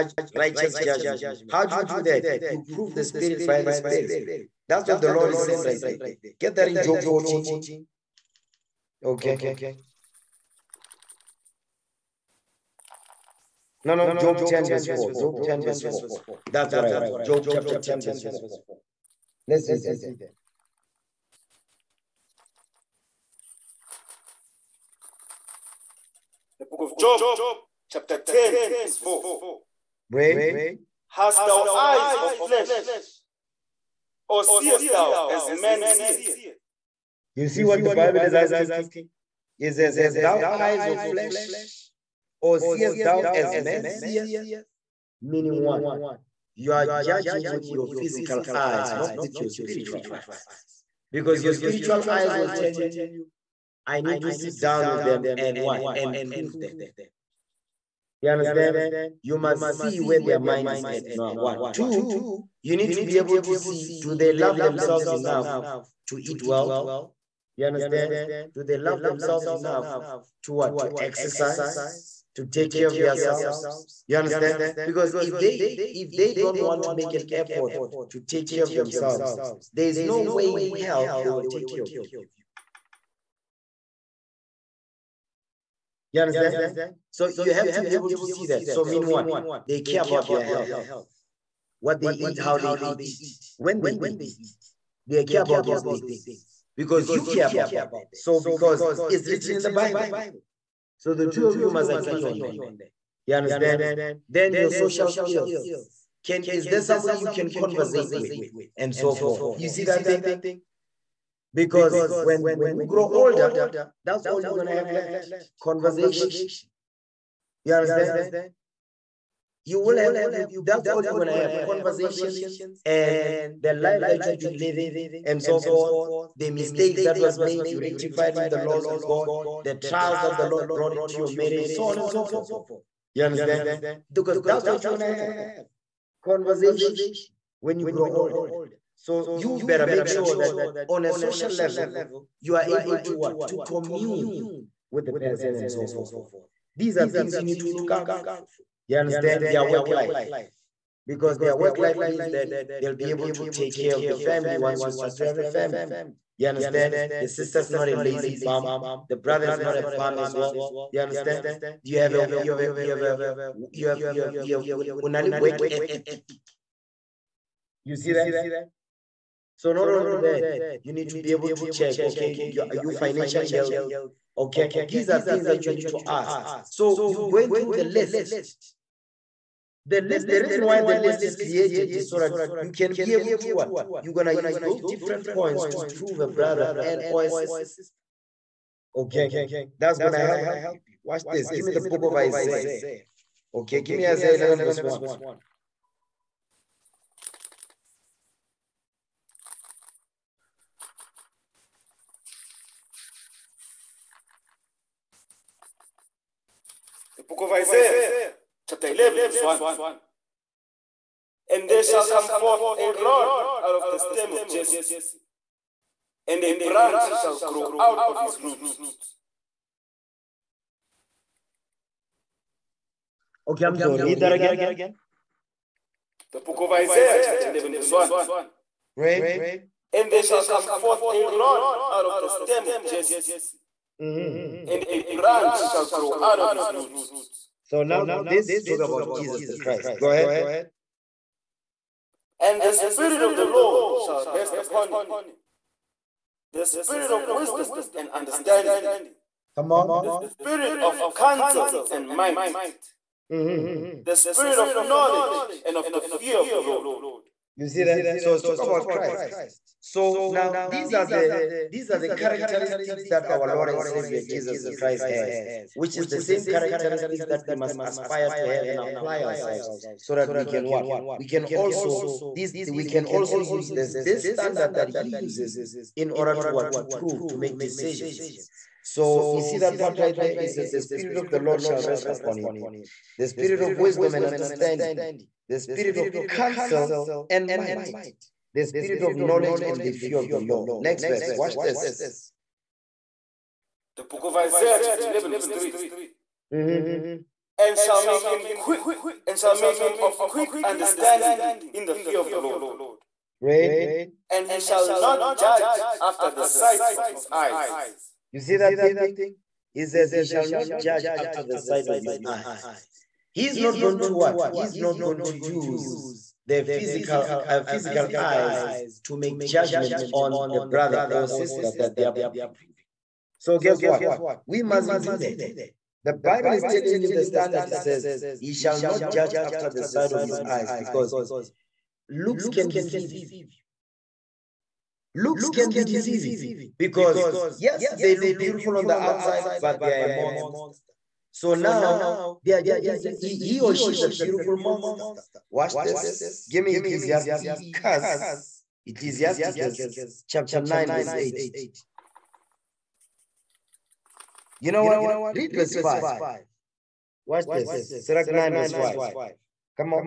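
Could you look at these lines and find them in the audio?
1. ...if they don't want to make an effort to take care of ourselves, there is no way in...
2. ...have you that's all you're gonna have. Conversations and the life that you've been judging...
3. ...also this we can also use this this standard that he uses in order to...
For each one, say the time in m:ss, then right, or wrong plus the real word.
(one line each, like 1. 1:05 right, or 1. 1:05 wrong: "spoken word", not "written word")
1. 1:15 wrong: "themselves", not "ourselves"
2. 1:59 wrong: "living", not "judging"
3. 4:31 right.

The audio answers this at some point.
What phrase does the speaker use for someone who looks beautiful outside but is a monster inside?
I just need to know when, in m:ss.
5:44.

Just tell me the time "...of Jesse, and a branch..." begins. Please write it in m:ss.
3:34.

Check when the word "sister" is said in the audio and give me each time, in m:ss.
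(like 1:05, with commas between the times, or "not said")
2:37, 3:07, 5:21.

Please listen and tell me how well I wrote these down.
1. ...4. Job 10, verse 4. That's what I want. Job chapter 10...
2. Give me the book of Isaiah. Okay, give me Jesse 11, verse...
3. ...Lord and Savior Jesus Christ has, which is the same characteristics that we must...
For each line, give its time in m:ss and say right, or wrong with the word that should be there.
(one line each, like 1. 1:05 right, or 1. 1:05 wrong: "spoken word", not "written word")
1. 0:14 right
2. 3:11 wrong: "Isaiah", not "Jesse"
3. 4:23 right.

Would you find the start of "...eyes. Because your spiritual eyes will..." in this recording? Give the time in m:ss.
0:50.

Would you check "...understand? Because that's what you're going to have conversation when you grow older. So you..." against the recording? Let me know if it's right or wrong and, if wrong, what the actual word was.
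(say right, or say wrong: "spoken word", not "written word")
right.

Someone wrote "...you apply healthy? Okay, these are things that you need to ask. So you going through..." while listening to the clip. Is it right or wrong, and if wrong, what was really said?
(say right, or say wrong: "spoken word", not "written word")
wrong: "financially", not "apply".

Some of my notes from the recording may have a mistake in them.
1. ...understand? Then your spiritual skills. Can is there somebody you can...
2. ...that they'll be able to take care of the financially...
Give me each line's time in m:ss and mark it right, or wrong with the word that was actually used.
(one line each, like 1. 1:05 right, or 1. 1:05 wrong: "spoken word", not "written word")
1. 1:43 wrong: "social", not "spiritual"
2. 2:32 wrong: "family", not "financially".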